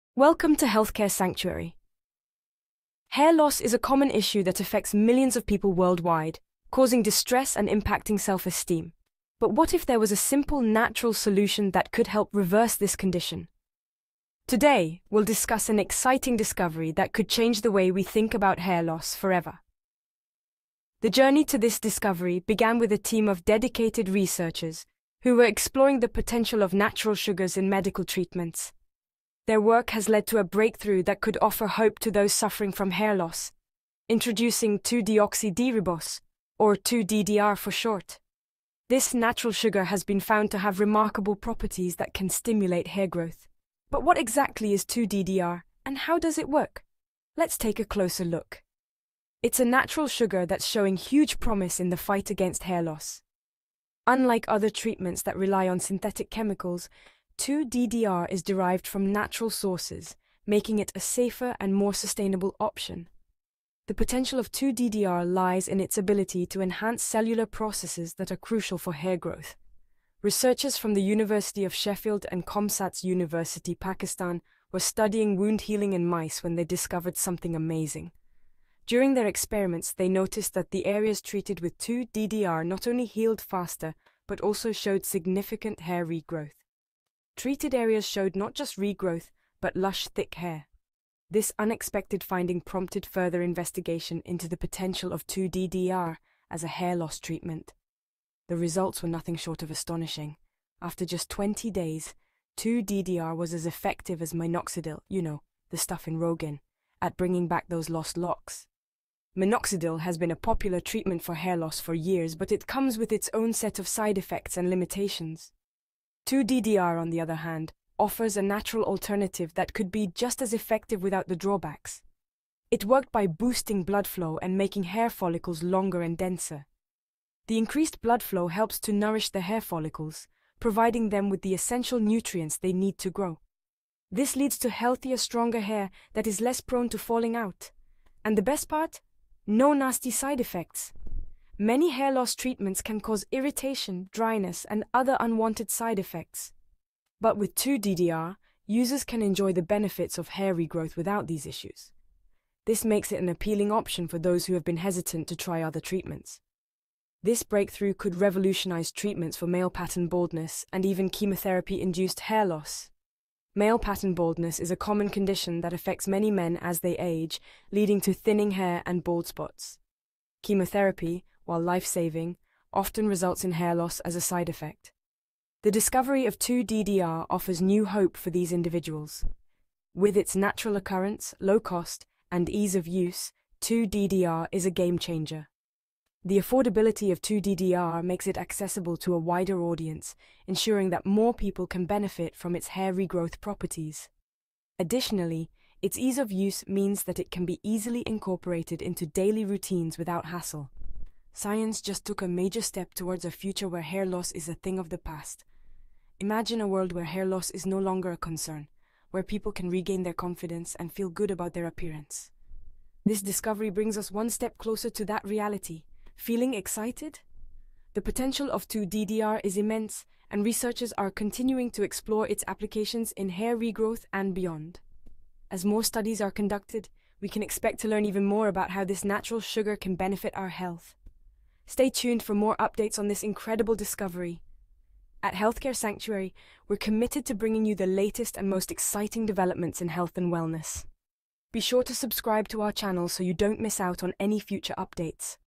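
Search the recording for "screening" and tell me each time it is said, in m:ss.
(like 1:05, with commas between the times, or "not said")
not said.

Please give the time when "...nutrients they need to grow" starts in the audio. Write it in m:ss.
2:11.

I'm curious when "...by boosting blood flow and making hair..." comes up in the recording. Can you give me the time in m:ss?
2:03.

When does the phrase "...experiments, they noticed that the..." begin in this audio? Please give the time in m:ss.
1:19.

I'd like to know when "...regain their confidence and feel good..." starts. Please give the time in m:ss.
3:29.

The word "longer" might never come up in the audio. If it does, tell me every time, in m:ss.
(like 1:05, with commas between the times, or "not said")
2:05, 3:27.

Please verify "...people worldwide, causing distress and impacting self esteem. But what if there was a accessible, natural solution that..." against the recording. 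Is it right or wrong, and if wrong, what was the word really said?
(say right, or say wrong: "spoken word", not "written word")
wrong: "simple", not "accessible".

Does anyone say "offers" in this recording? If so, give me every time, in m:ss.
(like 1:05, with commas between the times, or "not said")
0:31, 1:57, 2:57.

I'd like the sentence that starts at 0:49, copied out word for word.
It's a natural sugar that's showing huge promise in the fight against hair loss.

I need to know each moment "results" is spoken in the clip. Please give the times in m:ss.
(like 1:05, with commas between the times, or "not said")
1:38, 2:53.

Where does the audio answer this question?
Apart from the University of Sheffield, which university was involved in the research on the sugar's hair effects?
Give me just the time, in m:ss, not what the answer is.
1:12.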